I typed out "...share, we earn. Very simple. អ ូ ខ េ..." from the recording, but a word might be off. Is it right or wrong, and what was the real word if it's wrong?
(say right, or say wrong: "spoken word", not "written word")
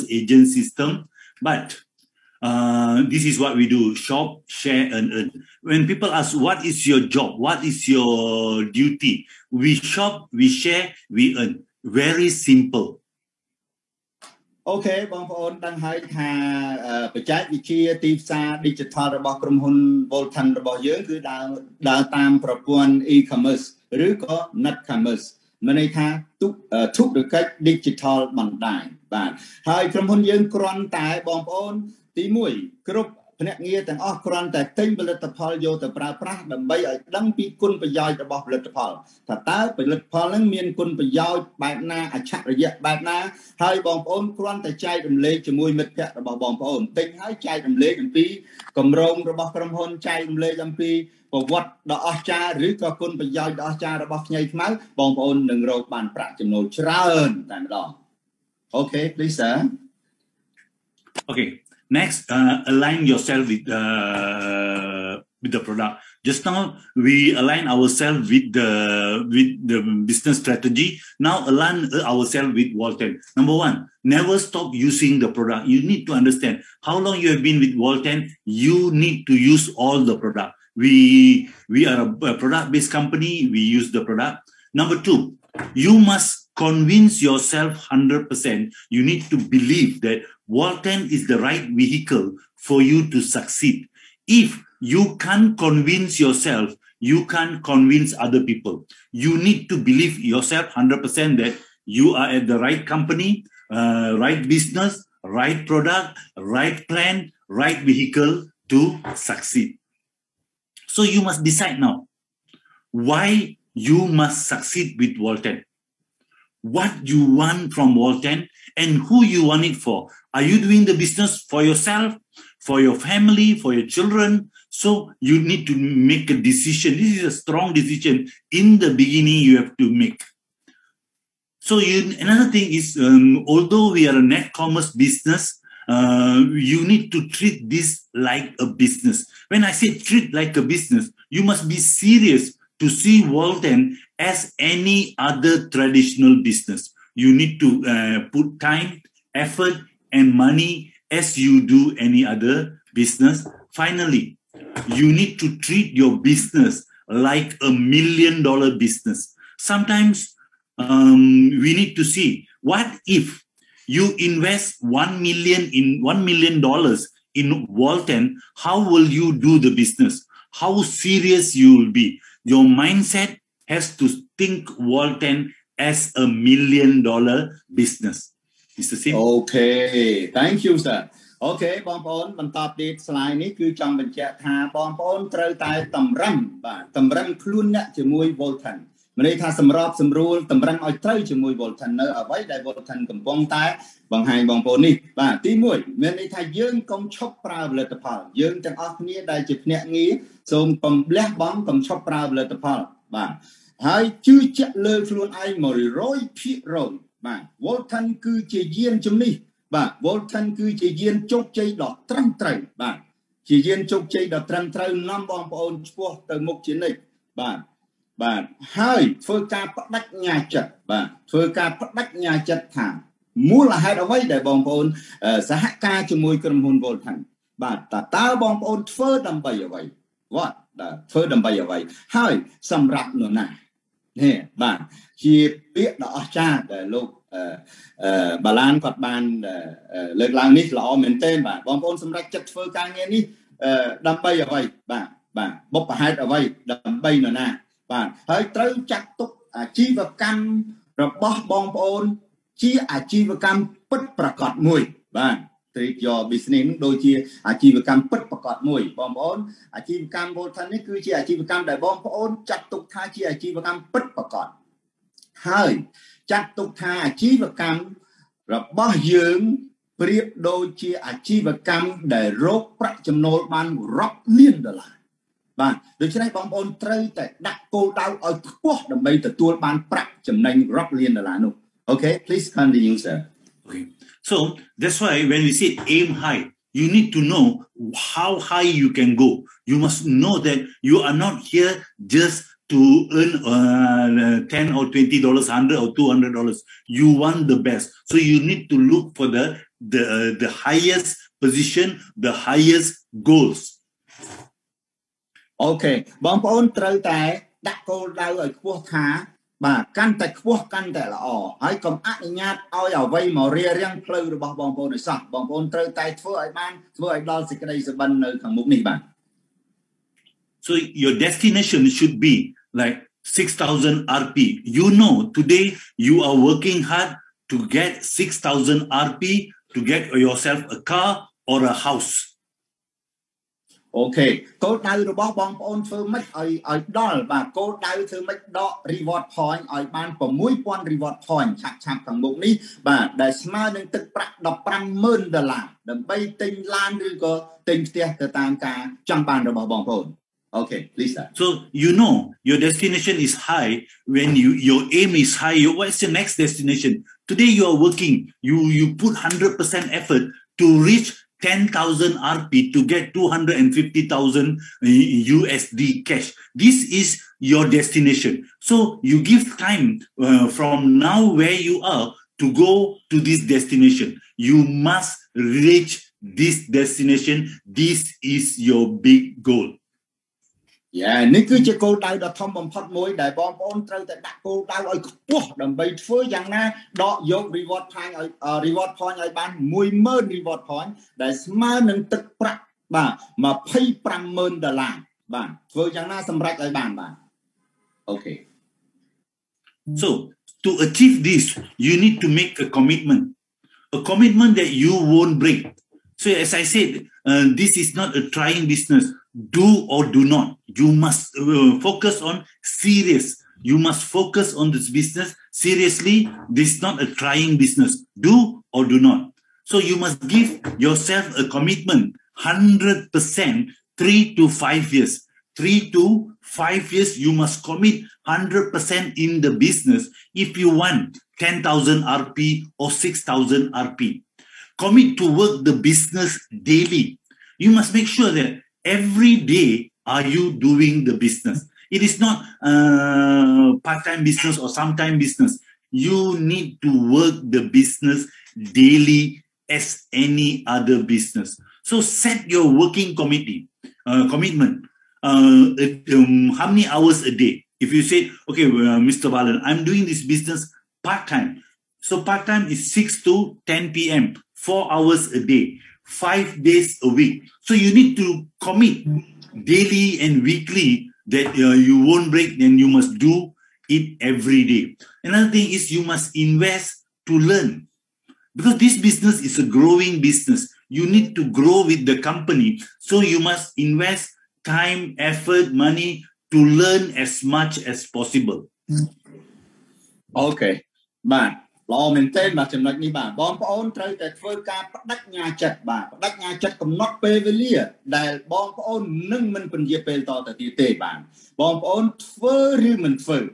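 right.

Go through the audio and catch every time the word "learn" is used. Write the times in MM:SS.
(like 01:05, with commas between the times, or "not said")
07:57, 08:06.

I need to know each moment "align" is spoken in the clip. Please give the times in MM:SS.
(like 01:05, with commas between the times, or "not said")
01:02, 01:07, 01:11.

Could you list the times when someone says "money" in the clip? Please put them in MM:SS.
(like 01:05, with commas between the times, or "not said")
02:30, 08:05.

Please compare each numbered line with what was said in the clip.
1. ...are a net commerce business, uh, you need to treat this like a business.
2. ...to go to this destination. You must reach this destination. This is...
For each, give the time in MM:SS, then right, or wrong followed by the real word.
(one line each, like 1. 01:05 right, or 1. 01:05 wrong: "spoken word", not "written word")
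1. 02:14 right
2. 06:12 right.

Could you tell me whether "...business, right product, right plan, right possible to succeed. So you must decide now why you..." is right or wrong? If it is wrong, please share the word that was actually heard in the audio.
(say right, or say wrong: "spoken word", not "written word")
wrong: "vehicle", not "possible".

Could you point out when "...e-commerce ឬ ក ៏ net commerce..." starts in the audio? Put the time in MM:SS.
00:23.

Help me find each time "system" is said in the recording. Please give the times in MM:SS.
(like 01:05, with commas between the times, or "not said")
00:00.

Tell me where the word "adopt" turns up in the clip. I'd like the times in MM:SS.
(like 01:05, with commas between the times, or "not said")
not said.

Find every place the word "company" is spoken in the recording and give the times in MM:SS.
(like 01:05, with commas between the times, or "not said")
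01:22, 01:42, 08:02.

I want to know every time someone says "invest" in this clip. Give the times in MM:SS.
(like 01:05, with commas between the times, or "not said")
02:44, 07:56, 08:03.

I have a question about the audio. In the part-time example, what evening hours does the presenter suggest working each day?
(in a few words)
6 to 10 p.m.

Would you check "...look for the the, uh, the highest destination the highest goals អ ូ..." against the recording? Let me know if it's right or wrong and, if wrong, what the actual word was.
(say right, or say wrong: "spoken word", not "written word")
wrong: "position", not "destination".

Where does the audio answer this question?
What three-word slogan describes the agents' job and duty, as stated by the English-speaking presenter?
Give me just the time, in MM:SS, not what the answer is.
00:03.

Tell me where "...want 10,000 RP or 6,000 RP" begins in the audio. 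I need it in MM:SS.
07:10.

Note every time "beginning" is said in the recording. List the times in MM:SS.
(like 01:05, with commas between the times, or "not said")
02:08.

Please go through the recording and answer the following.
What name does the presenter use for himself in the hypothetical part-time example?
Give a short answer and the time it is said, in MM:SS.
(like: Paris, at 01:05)
Mr. Balan, at 07:38.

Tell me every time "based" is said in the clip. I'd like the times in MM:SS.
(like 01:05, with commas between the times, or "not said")
01:22.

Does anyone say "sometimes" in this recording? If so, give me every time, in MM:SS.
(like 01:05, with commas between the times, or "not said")
02:39, 07:24.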